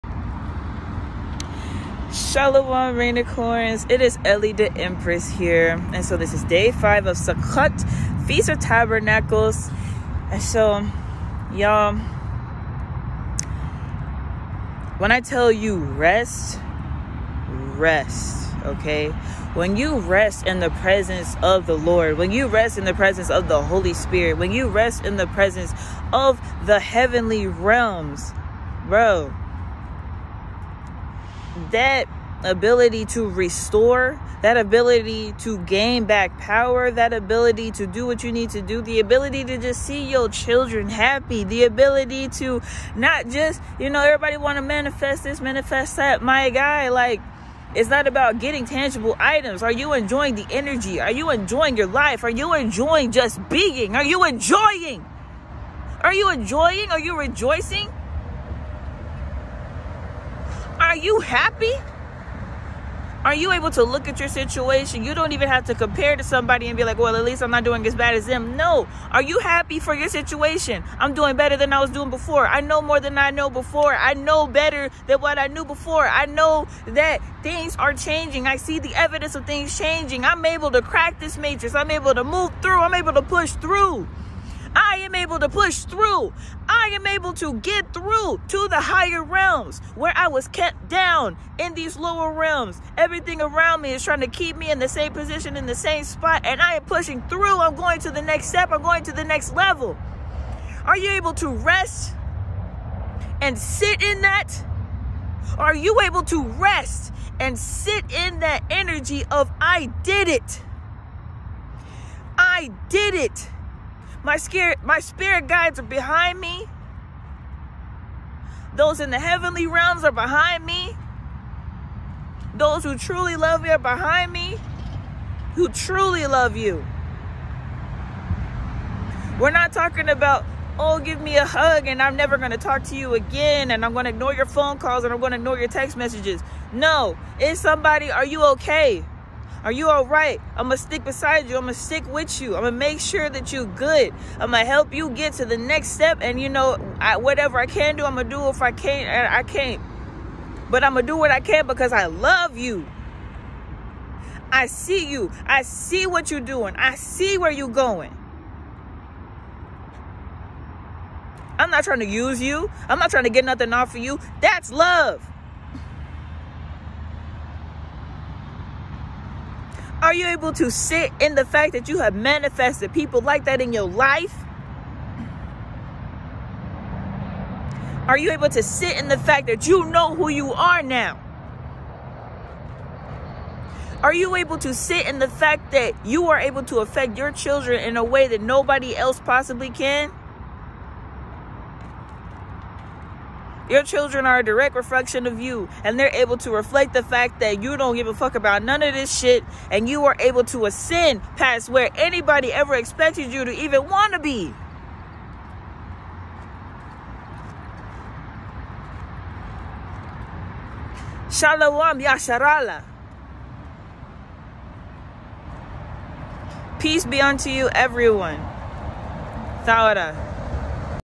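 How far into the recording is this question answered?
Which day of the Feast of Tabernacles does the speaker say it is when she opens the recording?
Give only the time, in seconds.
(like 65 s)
6 s.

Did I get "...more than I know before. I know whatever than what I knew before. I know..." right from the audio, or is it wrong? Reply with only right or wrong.
wrong.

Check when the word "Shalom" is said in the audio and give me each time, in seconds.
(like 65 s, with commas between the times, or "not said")
2 s, 211 s.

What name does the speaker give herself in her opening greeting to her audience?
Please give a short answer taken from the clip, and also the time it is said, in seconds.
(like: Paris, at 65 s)
Ellie the Empress, at 4 s.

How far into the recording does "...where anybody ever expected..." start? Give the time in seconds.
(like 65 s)
201 s.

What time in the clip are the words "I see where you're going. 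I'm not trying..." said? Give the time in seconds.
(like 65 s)
156 s.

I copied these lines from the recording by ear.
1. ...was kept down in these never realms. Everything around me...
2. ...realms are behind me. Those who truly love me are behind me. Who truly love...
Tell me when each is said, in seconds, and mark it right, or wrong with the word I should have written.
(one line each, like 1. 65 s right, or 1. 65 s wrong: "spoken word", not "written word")
1. 90 s wrong: "lower", not "never"
2. 119 s right.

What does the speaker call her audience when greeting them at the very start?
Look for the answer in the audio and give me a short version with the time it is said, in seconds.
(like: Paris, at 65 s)
Rainicorns, at 2 s.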